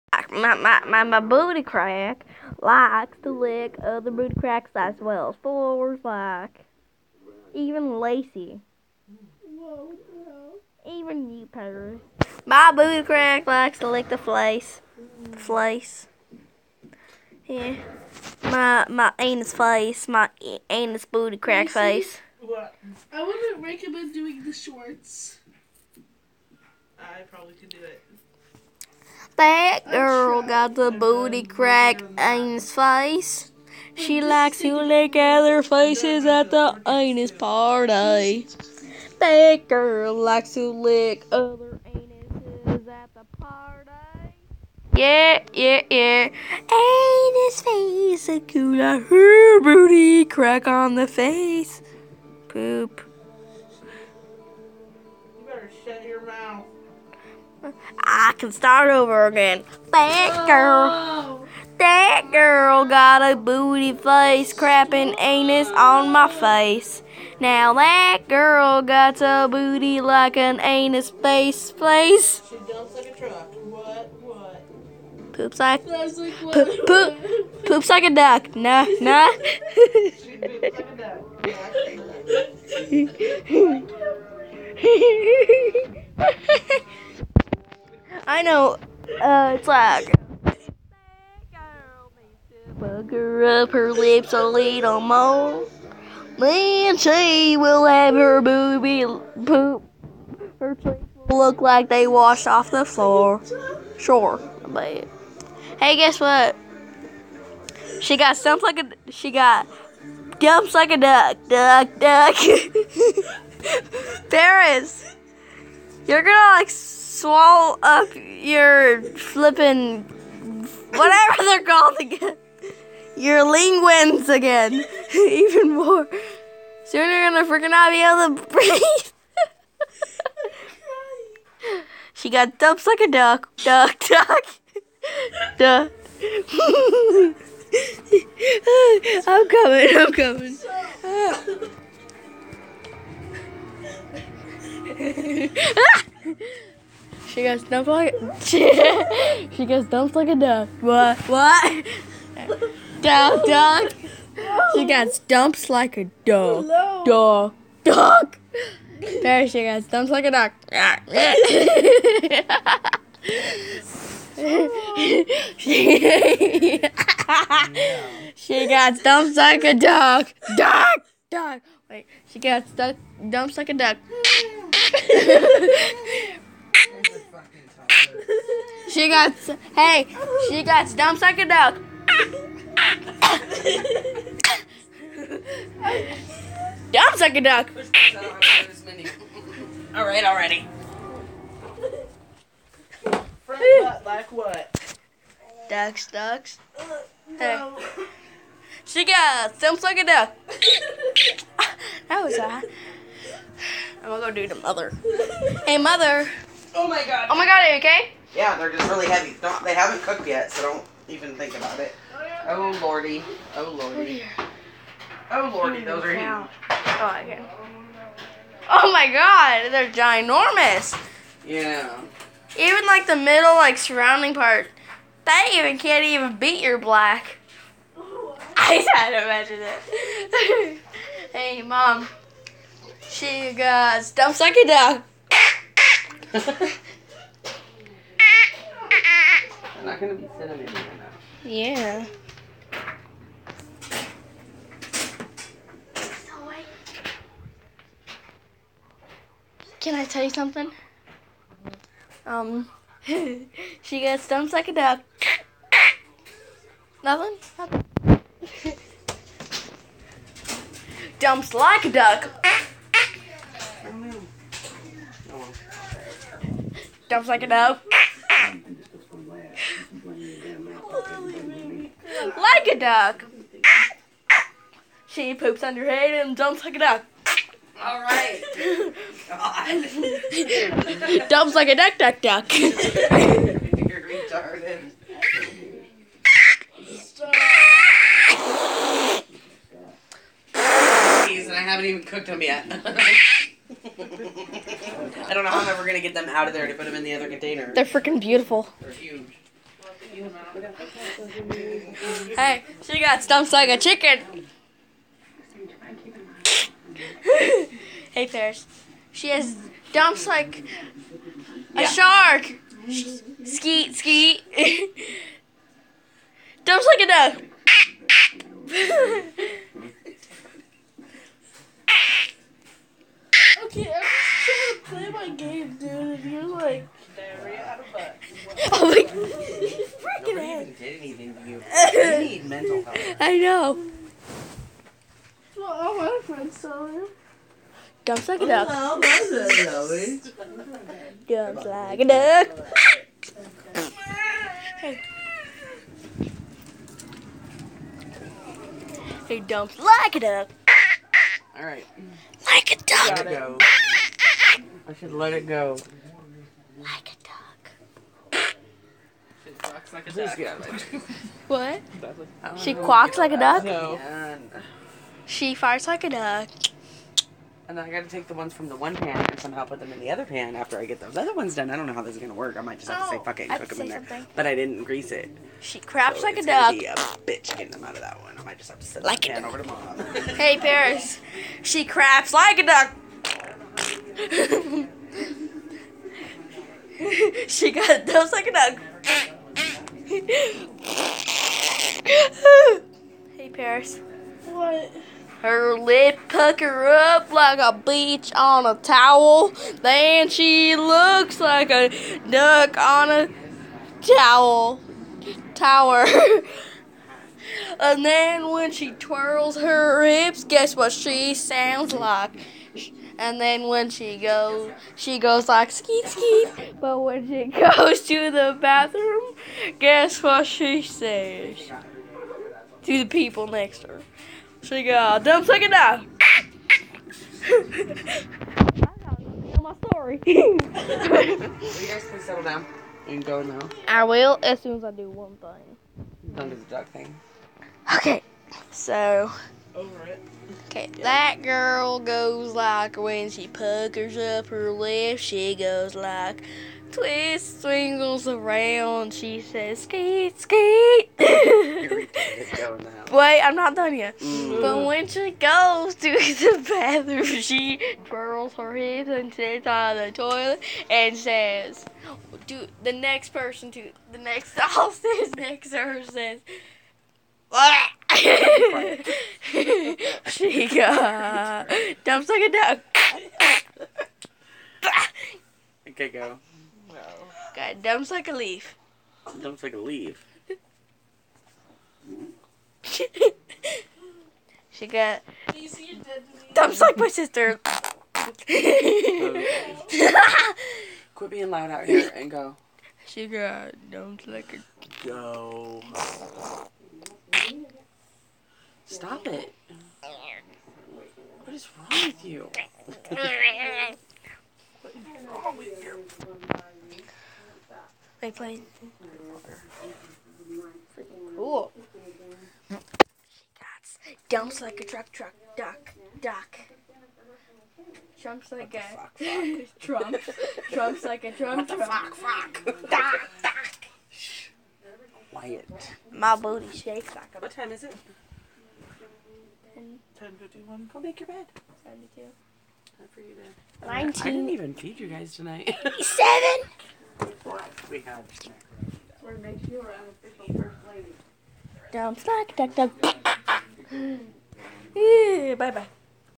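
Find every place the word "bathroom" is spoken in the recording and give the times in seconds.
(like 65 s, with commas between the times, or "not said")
418 s, 456 s.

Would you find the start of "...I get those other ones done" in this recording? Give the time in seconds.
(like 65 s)
370 s.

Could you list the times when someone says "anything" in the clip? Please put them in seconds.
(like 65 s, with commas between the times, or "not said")
331 s.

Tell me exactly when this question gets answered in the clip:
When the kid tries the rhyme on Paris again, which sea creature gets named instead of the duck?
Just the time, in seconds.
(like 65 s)
311 s.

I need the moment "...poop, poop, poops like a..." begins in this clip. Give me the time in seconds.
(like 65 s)
75 s.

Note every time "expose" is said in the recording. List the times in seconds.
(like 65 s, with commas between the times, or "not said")
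not said.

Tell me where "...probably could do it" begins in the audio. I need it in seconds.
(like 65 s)
27 s.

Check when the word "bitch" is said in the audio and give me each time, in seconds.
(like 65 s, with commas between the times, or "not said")
376 s.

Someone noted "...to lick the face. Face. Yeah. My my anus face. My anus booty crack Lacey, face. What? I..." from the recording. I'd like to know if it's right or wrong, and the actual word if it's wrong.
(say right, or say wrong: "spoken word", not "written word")
right.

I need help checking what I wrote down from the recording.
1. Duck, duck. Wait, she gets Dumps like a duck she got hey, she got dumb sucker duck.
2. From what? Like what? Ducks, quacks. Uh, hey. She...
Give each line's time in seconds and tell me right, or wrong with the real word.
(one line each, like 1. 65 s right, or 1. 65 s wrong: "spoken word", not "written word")
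1. 170 s right
2. 193 s wrong: "ducks", not "quacks".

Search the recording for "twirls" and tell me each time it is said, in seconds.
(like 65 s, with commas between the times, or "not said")
408 s, 458 s.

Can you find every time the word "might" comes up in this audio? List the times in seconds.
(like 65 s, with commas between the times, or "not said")
372 s, 378 s.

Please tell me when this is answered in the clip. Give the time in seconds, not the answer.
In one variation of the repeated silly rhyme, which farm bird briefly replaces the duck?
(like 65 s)
303 s.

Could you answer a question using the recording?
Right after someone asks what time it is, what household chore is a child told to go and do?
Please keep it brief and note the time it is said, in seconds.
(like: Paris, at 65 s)
Make your bed, at 530 s.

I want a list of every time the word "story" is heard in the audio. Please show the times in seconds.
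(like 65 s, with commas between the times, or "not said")
429 s.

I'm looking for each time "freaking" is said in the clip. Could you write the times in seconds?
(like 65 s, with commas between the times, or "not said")
127 s, 297 s, 330 s.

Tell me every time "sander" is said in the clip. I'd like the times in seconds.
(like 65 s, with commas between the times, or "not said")
not said.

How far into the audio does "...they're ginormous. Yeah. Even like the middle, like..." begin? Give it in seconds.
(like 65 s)
219 s.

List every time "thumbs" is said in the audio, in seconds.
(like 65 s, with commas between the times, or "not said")
199 s.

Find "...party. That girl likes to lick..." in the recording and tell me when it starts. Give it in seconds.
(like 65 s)
37 s.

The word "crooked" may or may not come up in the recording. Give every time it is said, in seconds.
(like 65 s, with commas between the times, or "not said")
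not said.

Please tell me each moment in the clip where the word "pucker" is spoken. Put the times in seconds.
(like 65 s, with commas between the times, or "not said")
396 s, 443 s.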